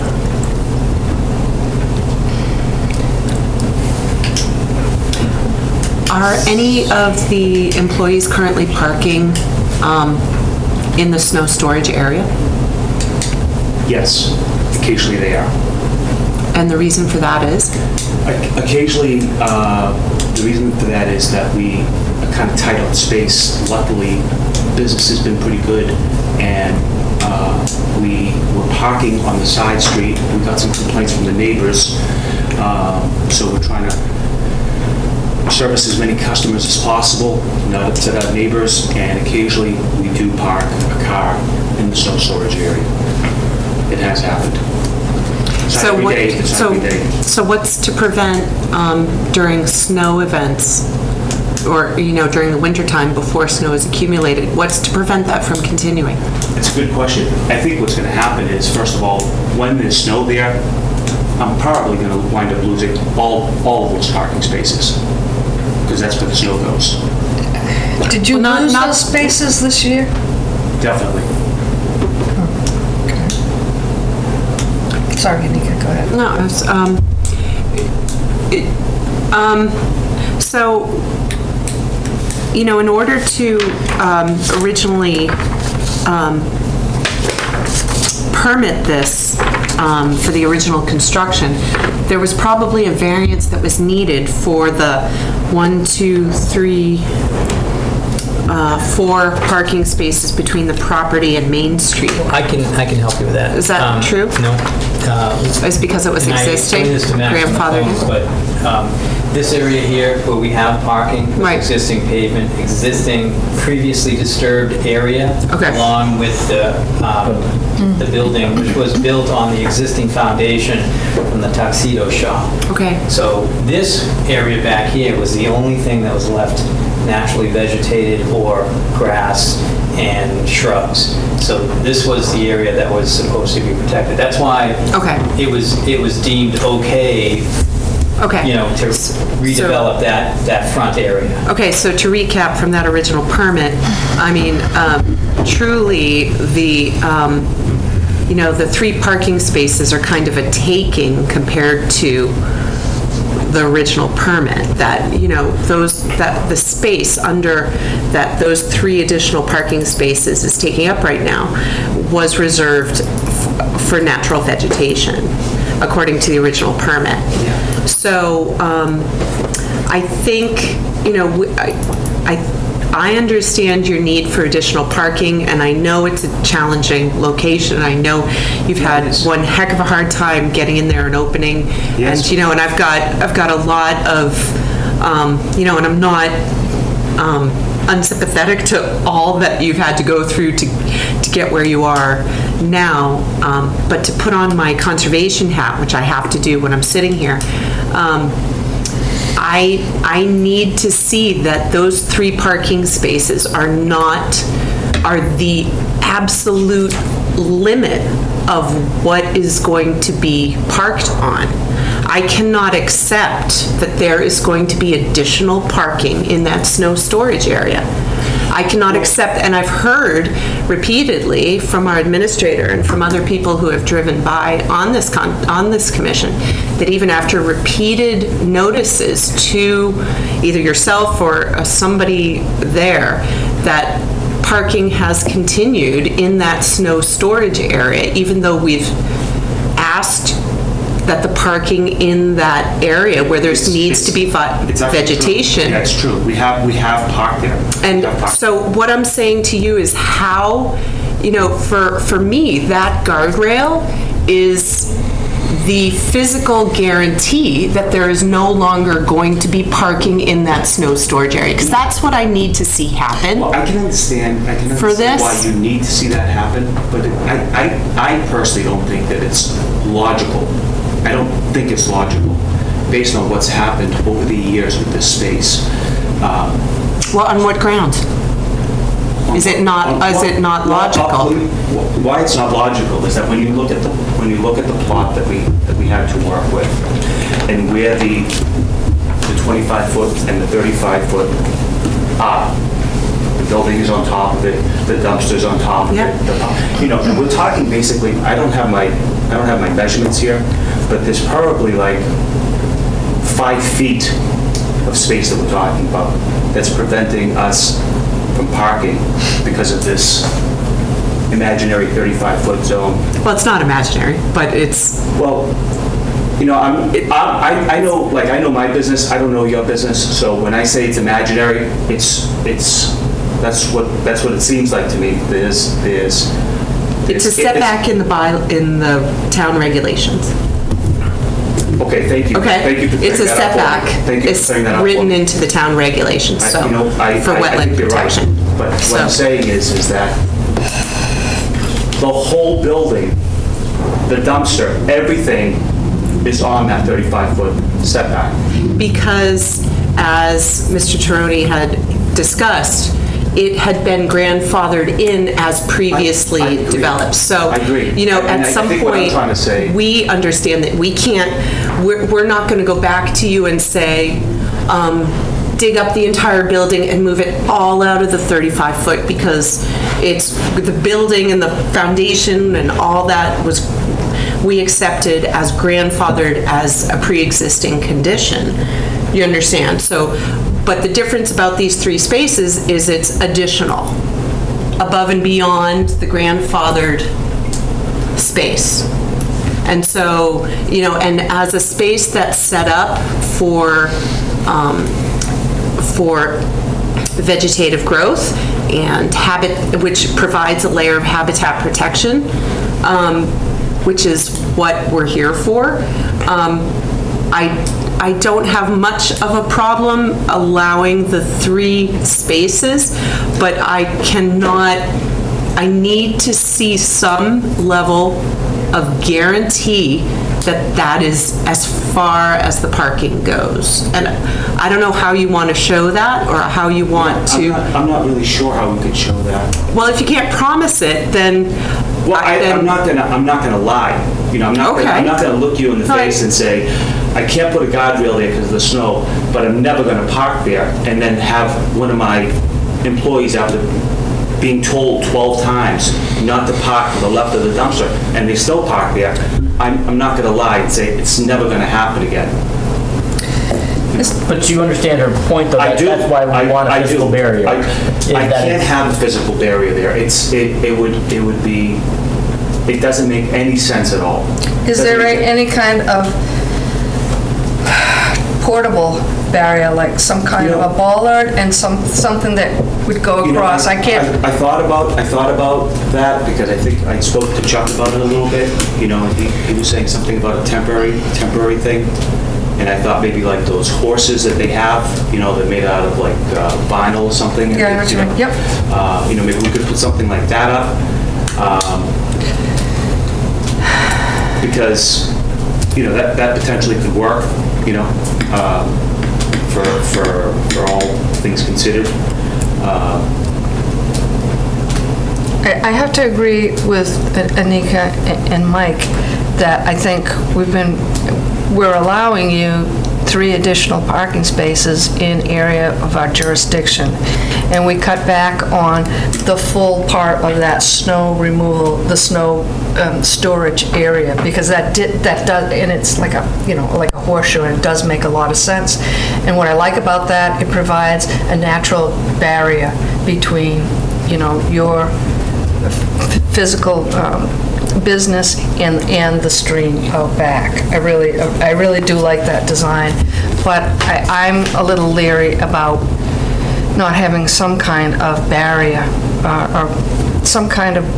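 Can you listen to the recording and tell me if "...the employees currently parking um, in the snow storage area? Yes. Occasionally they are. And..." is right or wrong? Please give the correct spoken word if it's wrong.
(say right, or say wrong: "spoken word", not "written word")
right.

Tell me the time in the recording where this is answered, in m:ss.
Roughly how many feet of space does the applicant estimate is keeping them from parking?
5:03.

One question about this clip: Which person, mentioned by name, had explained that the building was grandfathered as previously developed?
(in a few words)
Mr. Taroni.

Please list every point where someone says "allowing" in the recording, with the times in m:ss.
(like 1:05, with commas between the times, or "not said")
6:50, 8:31.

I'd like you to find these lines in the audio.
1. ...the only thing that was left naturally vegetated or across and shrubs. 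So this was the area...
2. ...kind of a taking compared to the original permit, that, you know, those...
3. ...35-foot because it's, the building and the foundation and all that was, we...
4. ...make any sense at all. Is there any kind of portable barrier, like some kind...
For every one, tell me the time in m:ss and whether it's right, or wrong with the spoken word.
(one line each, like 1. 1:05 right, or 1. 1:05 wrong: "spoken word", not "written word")
1. 2:05 wrong: "grass", not "across"
2. 2:30 right
3. 6:08 right
4. 7:43 right.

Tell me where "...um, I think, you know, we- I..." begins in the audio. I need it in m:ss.
2:48.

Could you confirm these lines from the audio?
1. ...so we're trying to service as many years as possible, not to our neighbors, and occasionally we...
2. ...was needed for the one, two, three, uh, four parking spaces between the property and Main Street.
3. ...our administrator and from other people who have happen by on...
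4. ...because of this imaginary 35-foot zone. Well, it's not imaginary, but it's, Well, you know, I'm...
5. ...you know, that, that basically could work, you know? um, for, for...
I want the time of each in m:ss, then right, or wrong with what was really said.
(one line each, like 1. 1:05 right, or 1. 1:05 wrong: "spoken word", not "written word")
1. 0:33 wrong: "customers", not "years"
2. 1:33 right
3. 3:41 wrong: "driven", not "happen"
4. 5:09 right
5. 8:15 wrong: "potentially", not "basically".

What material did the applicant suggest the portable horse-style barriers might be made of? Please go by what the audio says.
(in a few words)
vinyl.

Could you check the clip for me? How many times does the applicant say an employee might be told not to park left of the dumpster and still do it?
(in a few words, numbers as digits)
12.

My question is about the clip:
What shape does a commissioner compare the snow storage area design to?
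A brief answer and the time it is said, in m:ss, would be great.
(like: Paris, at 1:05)
horseshoe, at 8:47.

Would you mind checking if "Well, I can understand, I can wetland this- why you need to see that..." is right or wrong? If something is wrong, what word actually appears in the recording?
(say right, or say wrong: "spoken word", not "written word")
wrong: "understand", not "wetland".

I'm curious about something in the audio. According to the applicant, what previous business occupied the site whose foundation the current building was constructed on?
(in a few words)
tuxedo shop.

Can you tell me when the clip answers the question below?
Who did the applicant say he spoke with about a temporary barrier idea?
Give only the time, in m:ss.
7:57.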